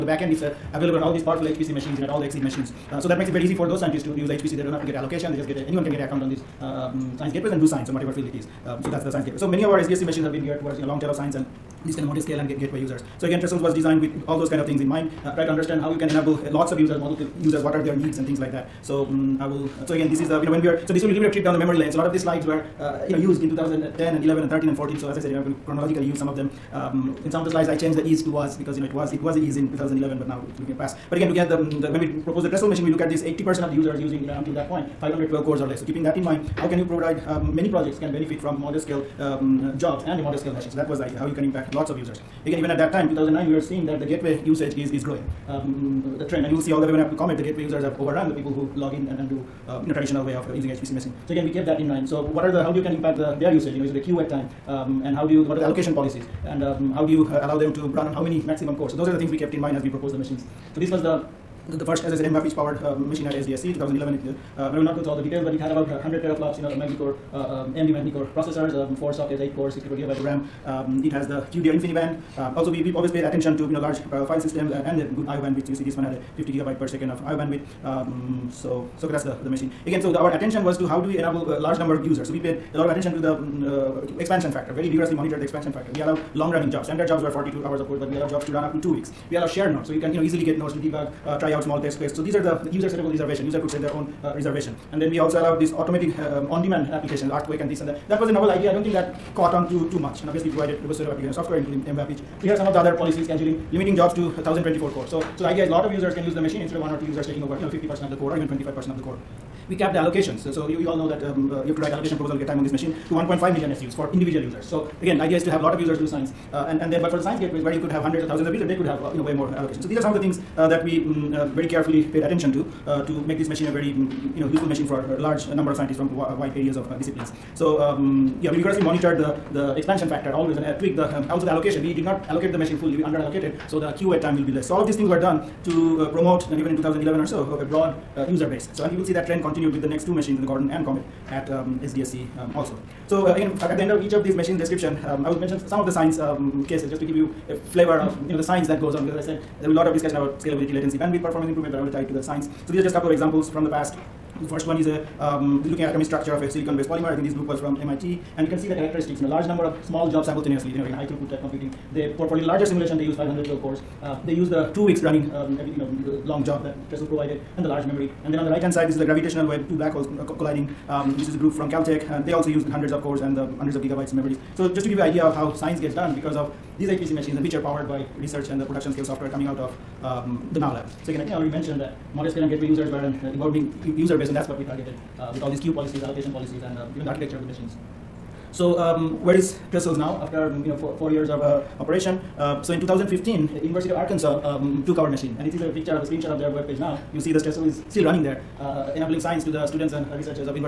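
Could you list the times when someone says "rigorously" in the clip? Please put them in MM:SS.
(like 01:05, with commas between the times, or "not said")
01:24, 02:08.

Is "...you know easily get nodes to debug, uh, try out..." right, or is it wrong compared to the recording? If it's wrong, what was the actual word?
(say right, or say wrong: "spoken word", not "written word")
right.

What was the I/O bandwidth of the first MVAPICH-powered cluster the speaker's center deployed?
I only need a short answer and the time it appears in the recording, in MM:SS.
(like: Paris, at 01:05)
50 gigabytes per second, at 01:16.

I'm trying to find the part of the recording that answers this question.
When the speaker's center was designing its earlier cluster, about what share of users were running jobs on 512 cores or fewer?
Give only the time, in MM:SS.
00:33.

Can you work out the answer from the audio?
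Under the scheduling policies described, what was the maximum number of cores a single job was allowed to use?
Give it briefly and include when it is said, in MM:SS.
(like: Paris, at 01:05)
1024, at 01:44.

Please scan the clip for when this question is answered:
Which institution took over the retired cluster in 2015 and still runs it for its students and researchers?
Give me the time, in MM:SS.
03:13.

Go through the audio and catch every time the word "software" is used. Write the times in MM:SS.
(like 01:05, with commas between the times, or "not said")
01:41, 02:59.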